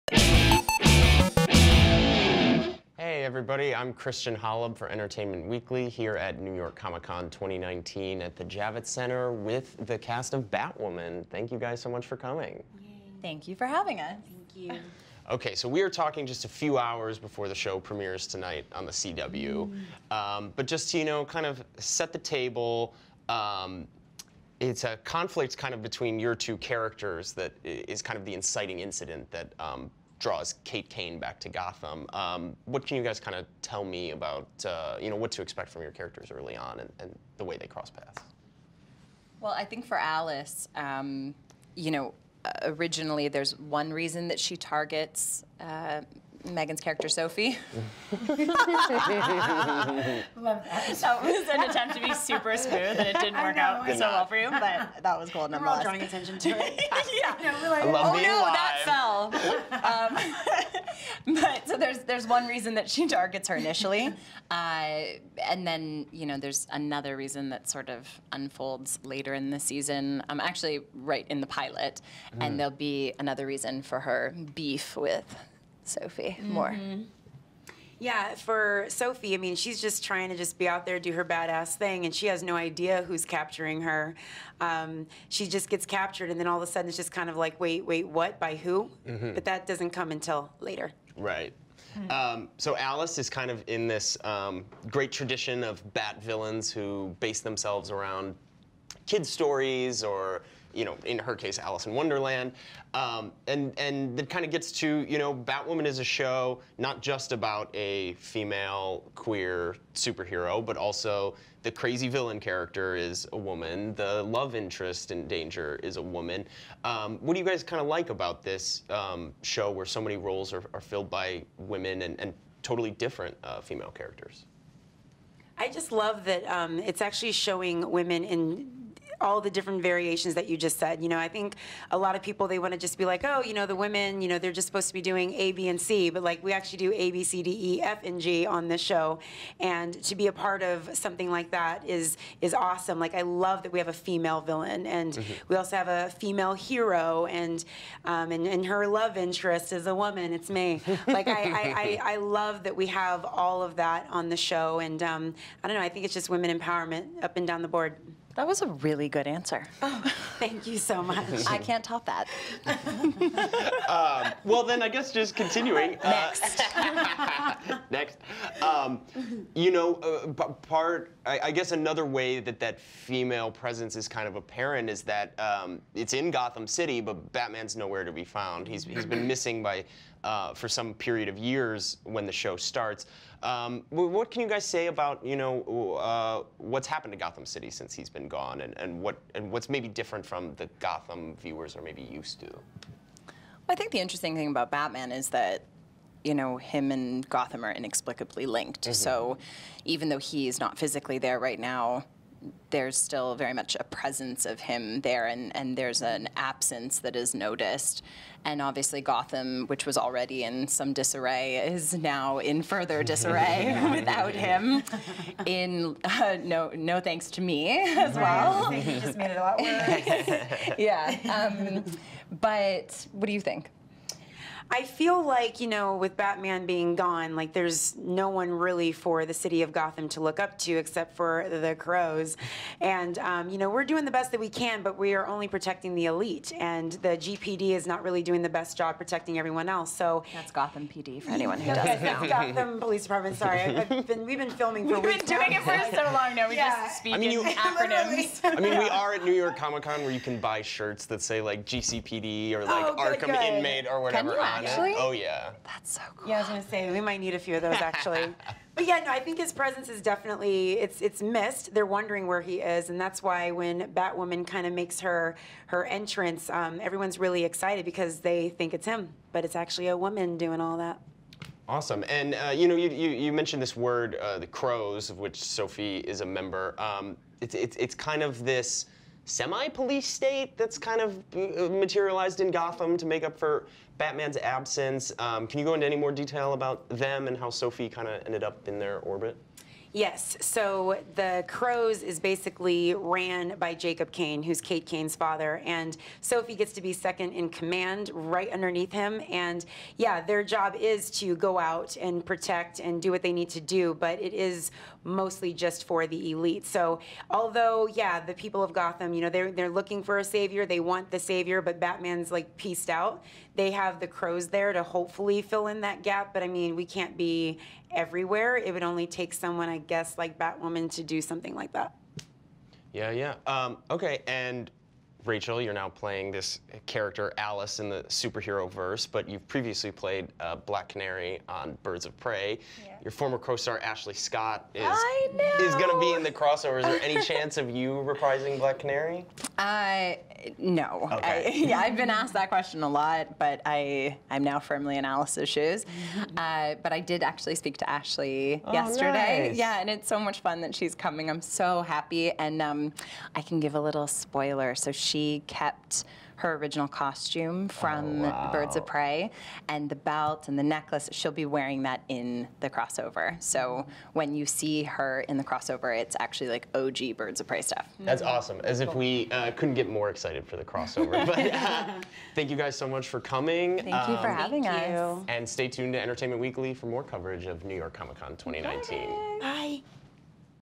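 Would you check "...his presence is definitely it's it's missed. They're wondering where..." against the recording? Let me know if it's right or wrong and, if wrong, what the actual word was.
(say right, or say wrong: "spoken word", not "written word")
right.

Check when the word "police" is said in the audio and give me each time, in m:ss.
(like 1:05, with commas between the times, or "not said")
4:02, 4:39.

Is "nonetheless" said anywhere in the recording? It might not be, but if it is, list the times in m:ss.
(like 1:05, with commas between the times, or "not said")
0:55.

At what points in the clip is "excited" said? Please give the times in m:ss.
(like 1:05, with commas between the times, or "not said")
4:27, 6:10.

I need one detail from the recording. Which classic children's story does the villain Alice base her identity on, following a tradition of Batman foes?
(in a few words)
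Alice in Wonderland.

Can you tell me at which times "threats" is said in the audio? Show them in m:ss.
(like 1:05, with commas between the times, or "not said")
not said.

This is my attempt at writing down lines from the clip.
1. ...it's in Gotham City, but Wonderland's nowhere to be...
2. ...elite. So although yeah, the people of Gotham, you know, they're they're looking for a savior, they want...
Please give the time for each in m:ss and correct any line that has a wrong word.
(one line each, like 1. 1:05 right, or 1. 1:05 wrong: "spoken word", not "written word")
1. 2:55 wrong: "Batman", not "Wonderland"
2. 5:06 right.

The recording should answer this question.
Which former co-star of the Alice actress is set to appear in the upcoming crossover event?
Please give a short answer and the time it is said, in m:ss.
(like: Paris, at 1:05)
Ashley Scott, at 5:33.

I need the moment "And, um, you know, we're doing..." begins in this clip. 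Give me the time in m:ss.
3:52.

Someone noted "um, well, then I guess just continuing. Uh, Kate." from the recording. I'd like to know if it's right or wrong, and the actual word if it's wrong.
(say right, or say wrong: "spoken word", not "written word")
wrong: "Next", not "Kate".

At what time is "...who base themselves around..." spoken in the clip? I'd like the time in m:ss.
1:36.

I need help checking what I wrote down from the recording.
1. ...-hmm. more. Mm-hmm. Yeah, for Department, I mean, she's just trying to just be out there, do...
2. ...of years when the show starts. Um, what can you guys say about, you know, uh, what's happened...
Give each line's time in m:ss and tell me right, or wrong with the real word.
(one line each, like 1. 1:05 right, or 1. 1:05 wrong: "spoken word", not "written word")
1. 1:16 wrong: "Sophie", not "Department"
2. 3:01 right.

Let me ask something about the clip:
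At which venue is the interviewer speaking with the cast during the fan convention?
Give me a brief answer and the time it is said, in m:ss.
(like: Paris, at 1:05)
Javits Center, at 0:08.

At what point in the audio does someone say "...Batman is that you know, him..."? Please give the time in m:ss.
3:14.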